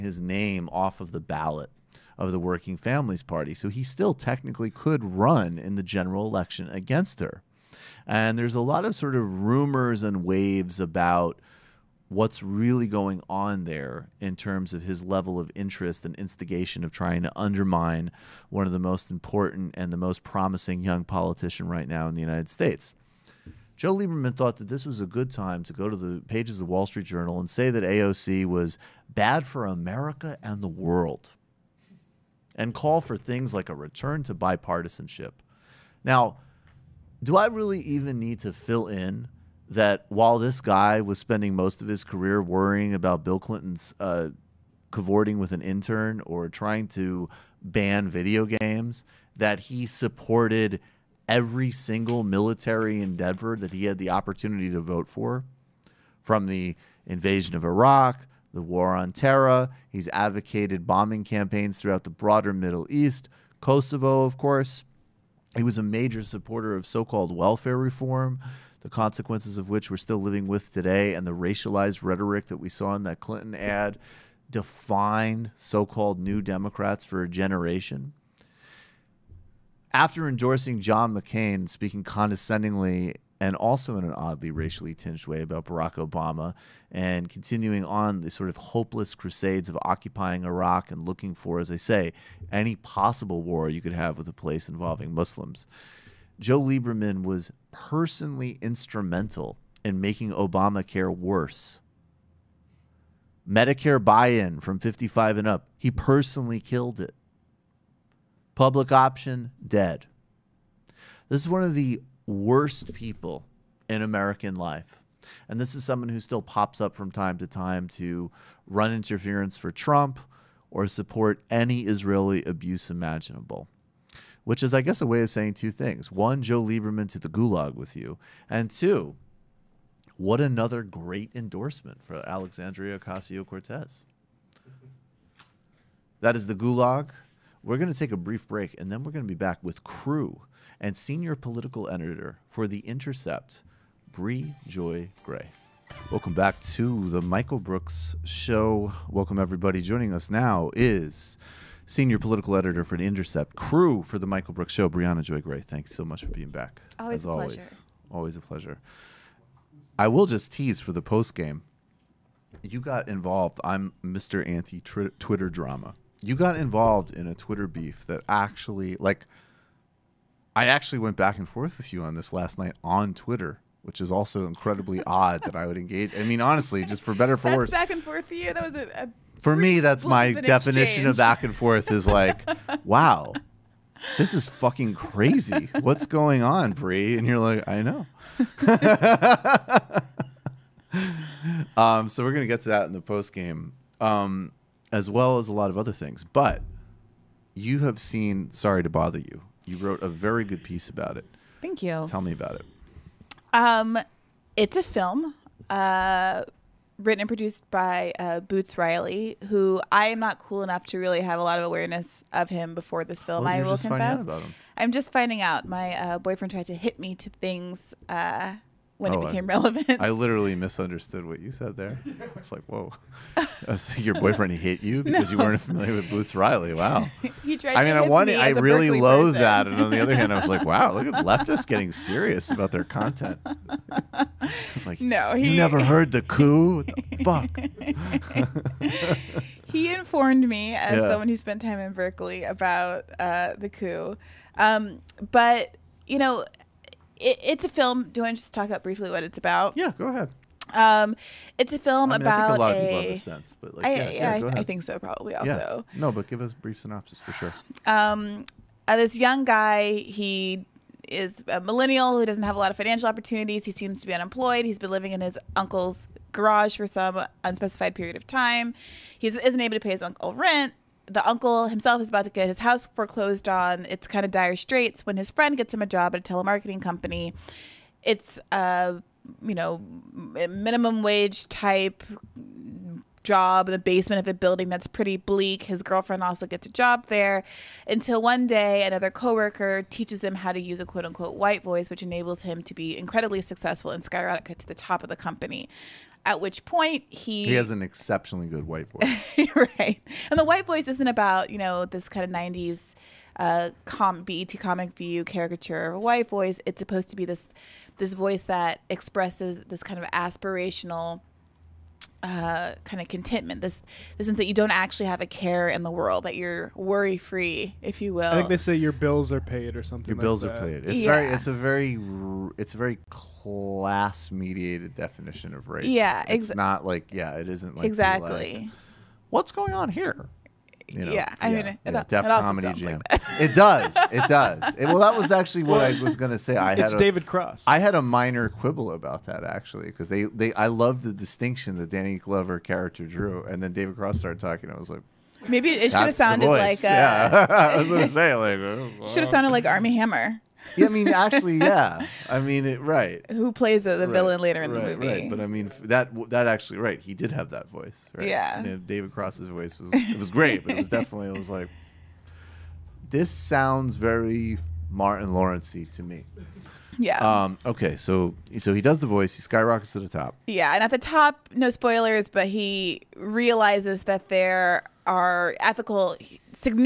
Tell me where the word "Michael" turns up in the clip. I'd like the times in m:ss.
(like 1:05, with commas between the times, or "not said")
2:27, 2:34.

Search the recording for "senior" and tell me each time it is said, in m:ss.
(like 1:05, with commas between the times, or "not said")
2:20, 2:31.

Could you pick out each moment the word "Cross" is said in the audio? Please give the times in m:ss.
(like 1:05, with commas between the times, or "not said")
5:37, 5:43, 5:59.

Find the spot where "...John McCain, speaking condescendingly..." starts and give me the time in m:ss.
1:20.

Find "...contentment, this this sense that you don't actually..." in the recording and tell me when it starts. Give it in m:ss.
5:13.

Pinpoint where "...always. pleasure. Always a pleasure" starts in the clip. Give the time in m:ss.
2:37.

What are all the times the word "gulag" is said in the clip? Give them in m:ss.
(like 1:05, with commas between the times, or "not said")
2:07, 2:16.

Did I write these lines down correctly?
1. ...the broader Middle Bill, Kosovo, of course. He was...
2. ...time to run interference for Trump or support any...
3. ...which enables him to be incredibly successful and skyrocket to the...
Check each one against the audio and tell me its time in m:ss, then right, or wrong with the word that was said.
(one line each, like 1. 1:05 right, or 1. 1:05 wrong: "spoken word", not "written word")
1. 1:02 wrong: "East", not "Bill"
2. 1:57 right
3. 4:51 right.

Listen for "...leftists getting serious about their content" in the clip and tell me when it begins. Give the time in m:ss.
3:51.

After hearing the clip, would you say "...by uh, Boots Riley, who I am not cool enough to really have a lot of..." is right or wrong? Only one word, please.
right.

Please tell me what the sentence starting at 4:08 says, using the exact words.
Do I just talk about briefly what it's about?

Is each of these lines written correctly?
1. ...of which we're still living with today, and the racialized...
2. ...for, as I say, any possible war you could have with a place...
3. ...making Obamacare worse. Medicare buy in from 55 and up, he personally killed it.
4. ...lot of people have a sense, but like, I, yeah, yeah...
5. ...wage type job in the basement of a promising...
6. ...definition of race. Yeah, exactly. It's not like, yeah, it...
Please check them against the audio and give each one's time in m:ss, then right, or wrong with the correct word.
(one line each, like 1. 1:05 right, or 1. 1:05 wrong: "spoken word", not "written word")
1. 1:09 right
2. 1:31 right
3. 1:39 right
4. 4:12 right
5. 4:41 wrong: "building", not "promising"
6. 5:24 right.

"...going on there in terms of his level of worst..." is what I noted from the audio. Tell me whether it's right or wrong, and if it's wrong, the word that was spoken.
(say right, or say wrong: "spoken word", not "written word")
wrong: "interest", not "worst".